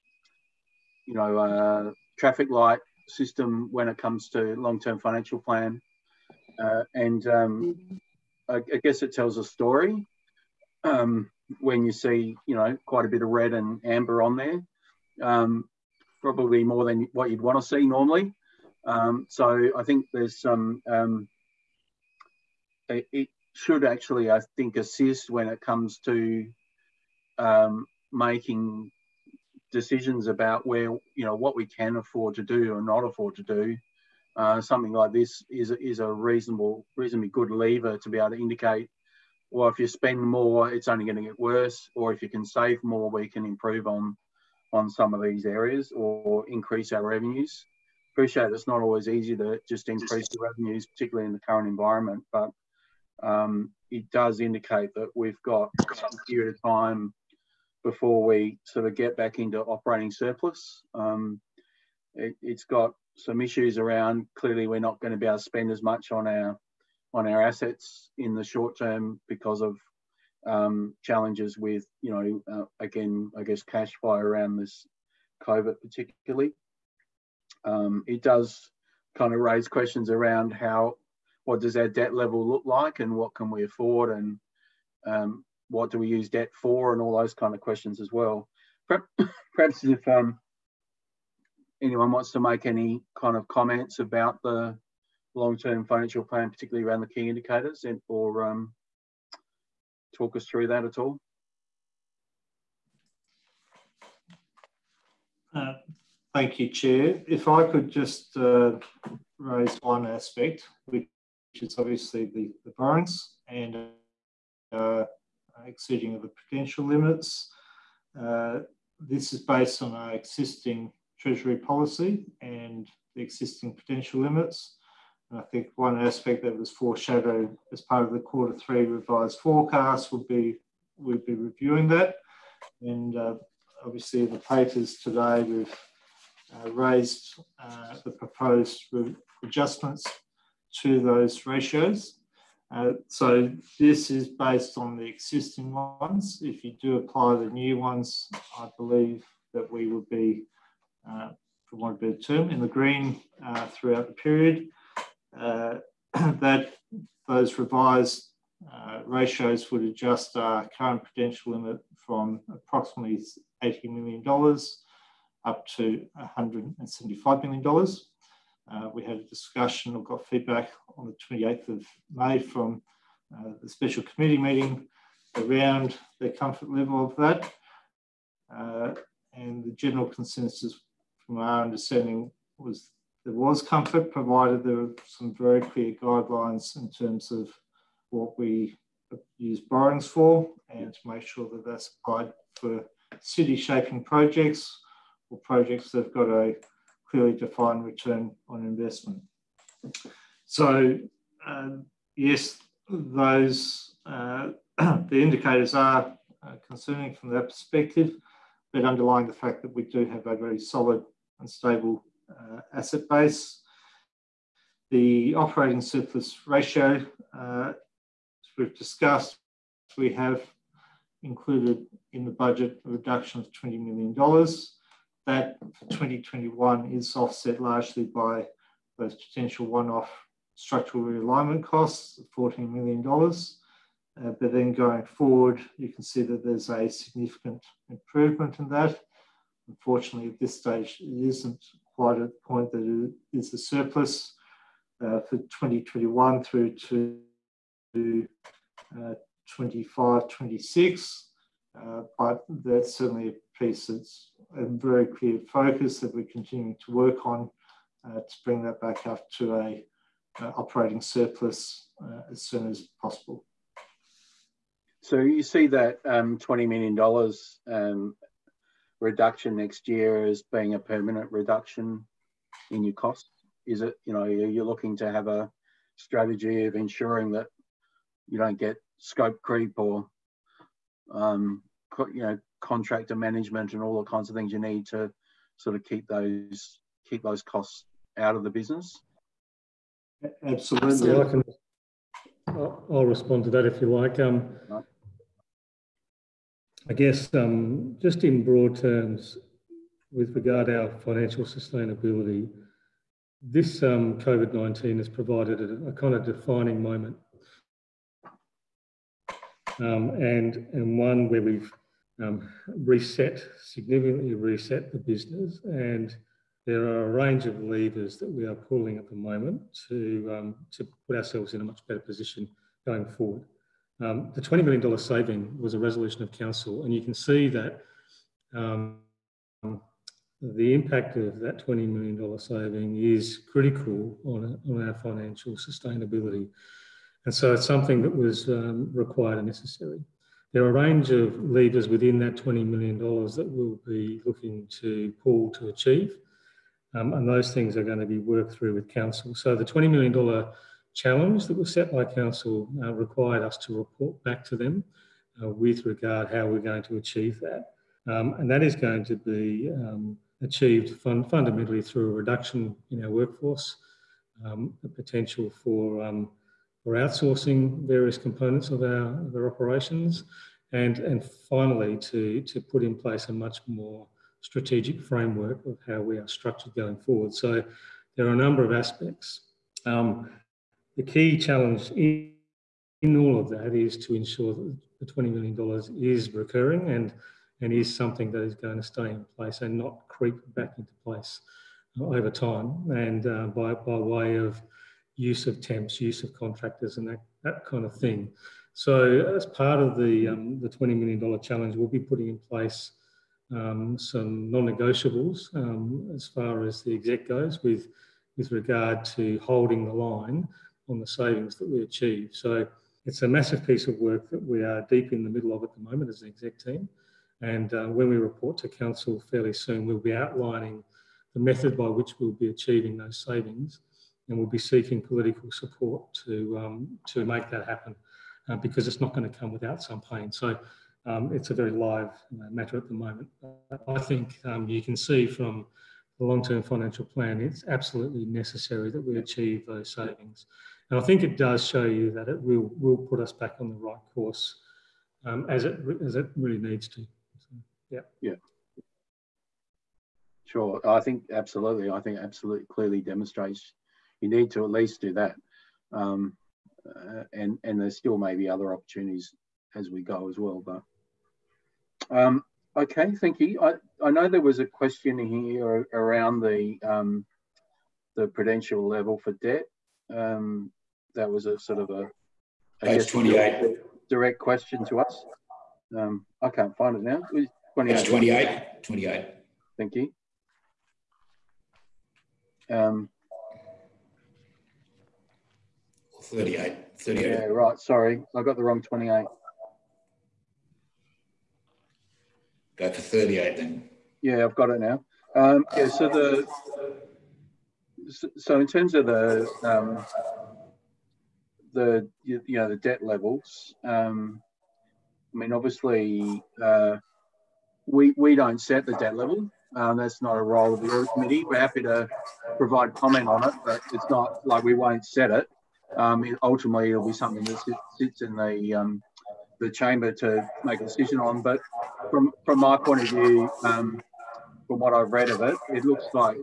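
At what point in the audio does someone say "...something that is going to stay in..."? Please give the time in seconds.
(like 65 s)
387 s.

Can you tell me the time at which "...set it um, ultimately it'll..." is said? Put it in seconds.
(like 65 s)
515 s.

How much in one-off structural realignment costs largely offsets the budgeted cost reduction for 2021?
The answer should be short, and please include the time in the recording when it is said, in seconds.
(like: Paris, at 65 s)
$14 million, at 232 s.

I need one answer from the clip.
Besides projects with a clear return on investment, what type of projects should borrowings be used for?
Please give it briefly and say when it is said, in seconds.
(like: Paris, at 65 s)
City shaping projects, at 193 s.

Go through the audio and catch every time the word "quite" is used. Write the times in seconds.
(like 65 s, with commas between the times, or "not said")
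12 s, 241 s.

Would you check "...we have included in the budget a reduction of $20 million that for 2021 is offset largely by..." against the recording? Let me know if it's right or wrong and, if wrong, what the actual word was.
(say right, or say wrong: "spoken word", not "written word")
right.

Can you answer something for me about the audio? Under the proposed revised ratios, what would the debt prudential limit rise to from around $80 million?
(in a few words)
$175 million.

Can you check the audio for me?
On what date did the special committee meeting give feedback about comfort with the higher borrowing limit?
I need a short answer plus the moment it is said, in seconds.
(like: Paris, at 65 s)
28th of May, at 171 s.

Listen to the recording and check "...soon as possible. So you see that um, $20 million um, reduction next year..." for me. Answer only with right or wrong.
right.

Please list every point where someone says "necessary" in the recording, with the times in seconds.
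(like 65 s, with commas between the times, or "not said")
339 s, 438 s.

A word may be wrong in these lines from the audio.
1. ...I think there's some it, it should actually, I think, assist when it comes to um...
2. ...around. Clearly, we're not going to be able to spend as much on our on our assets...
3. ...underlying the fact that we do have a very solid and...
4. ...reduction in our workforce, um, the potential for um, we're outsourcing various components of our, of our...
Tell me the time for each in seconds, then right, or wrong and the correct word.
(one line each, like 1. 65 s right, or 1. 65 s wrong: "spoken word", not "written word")
1. 19 s right
2. 63 s right
3. 208 s right
4. 362 s right.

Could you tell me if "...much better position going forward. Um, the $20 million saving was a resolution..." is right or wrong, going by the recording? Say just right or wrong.
right.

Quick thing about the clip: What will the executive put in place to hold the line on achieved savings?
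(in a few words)
Non negotiables.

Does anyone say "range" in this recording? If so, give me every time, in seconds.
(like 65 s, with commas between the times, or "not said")
317 s, 340 s.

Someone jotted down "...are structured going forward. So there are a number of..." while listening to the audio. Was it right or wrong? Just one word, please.
right.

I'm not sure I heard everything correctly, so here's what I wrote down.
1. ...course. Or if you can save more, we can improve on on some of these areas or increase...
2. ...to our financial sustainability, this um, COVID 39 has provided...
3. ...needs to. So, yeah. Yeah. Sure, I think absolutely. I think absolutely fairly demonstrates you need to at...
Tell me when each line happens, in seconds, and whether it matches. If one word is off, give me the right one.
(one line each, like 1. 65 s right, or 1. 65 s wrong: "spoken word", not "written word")
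1. 41 s wrong: "worse", not "course"
2. 300 s wrong: "19", not "39"
3. 446 s wrong: "clearly", not "fairly".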